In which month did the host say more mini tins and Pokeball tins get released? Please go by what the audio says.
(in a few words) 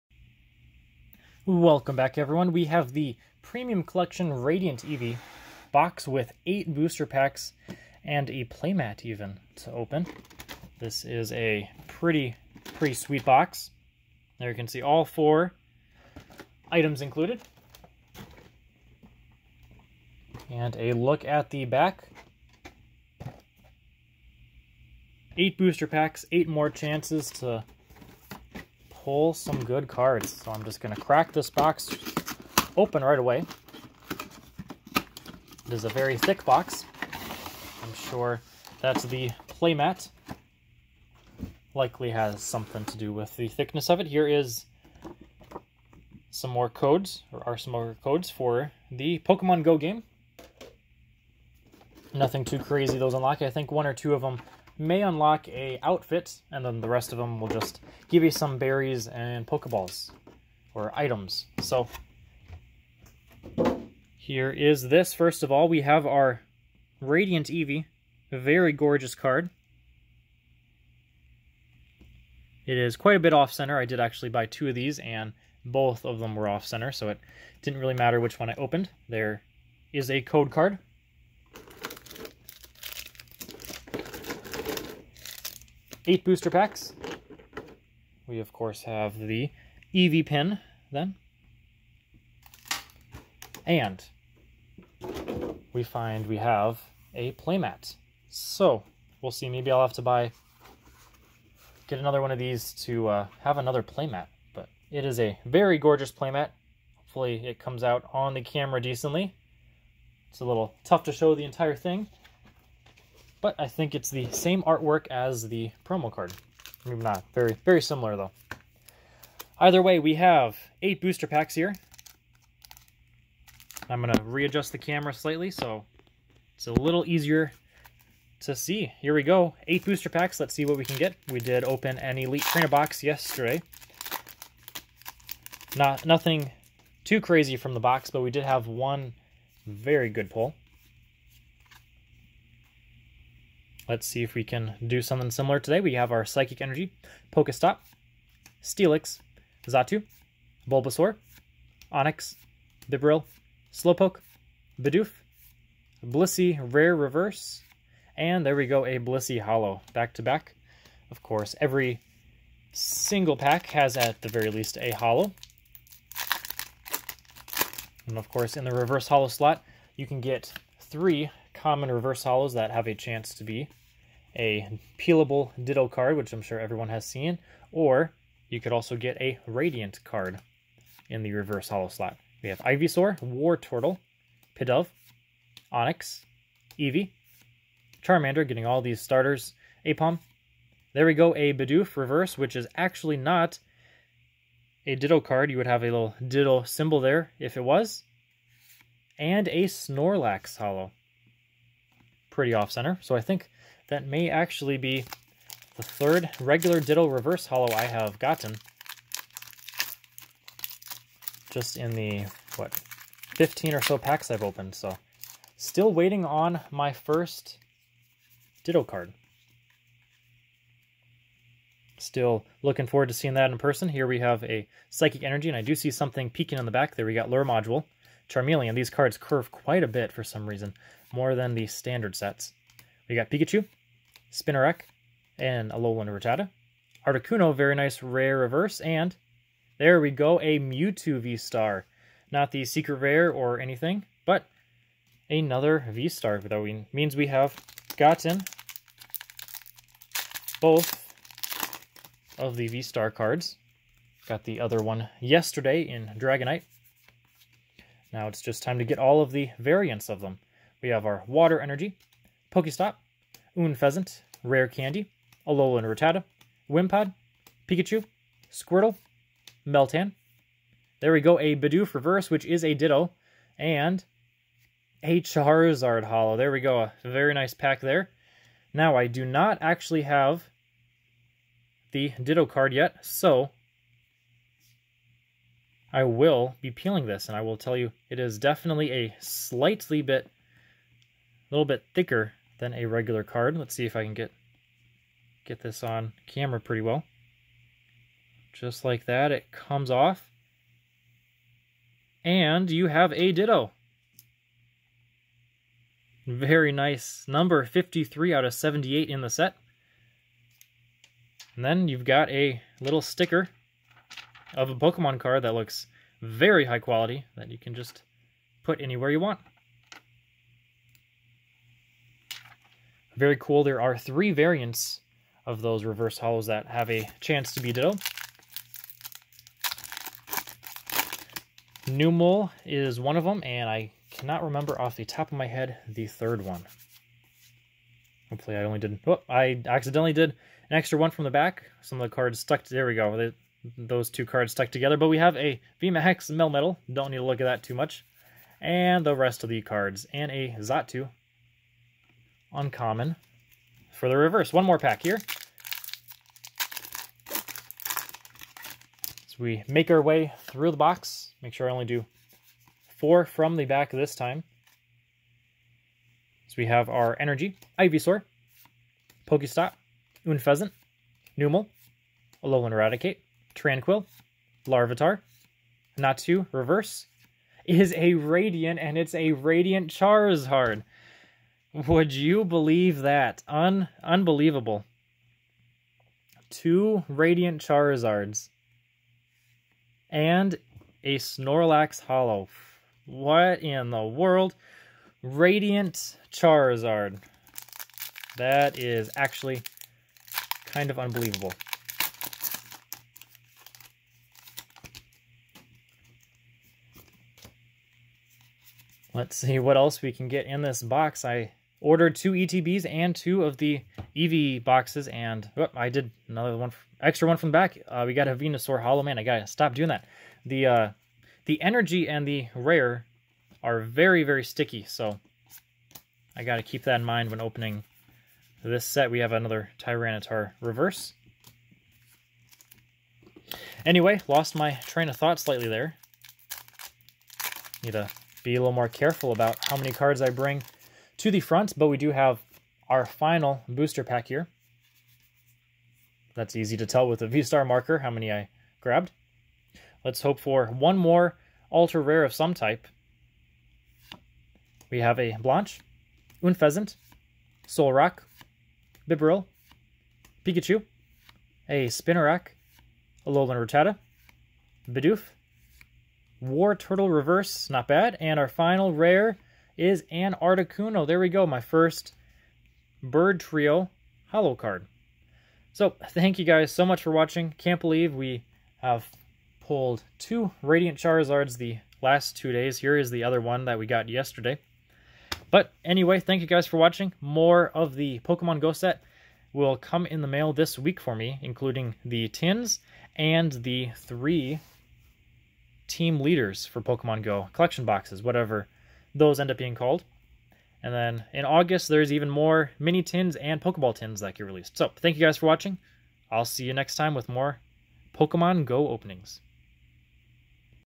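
August.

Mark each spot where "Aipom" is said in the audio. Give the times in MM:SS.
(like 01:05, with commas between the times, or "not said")
03:09.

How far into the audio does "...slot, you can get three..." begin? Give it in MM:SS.
02:49.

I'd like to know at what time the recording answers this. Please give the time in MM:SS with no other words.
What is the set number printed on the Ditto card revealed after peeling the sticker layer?
05:07.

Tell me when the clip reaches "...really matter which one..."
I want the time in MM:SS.
01:17.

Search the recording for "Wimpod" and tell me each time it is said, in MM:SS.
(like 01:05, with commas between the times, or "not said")
04:26.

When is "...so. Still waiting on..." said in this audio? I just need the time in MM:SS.
03:34.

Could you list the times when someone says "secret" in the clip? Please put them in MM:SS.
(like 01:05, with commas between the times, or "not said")
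04:02.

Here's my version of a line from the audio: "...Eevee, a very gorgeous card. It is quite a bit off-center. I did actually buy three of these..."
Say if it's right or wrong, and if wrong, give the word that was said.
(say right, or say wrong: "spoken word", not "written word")
wrong: "two", not "three".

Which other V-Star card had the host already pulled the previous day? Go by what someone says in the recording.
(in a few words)
Dragonite.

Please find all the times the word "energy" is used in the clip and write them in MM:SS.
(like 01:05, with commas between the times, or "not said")
02:26, 03:45, 04:21, 06:07, 07:01.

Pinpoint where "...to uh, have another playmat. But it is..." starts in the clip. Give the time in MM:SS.
01:42.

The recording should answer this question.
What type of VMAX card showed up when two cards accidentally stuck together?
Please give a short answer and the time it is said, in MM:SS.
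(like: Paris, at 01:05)
Melmetal, at 05:46.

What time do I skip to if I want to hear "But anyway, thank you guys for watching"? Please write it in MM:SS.
08:05.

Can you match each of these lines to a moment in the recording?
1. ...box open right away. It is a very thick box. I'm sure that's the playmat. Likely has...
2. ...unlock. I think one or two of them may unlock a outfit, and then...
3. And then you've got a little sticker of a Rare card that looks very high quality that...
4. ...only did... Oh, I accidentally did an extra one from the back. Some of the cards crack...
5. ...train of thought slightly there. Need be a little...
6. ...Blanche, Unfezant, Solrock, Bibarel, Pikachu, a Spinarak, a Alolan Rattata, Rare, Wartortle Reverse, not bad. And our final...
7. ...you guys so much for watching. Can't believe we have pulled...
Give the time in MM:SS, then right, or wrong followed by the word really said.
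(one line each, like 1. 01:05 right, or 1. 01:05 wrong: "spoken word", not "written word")
1. 00:31 right
2. 00:53 right
3. 05:11 wrong: "Pokemon", not "Rare"
4. 05:38 wrong: "stuck", not "crack"
5. 07:14 right
6. 07:35 wrong: "Bidoof", not "Rare"
7. 07:56 right.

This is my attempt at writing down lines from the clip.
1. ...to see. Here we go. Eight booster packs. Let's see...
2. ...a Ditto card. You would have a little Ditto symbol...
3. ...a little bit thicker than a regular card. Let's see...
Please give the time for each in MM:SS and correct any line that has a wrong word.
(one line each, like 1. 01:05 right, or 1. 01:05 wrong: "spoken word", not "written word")
1. 02:08 right
2. 03:14 right
3. 04:50 right.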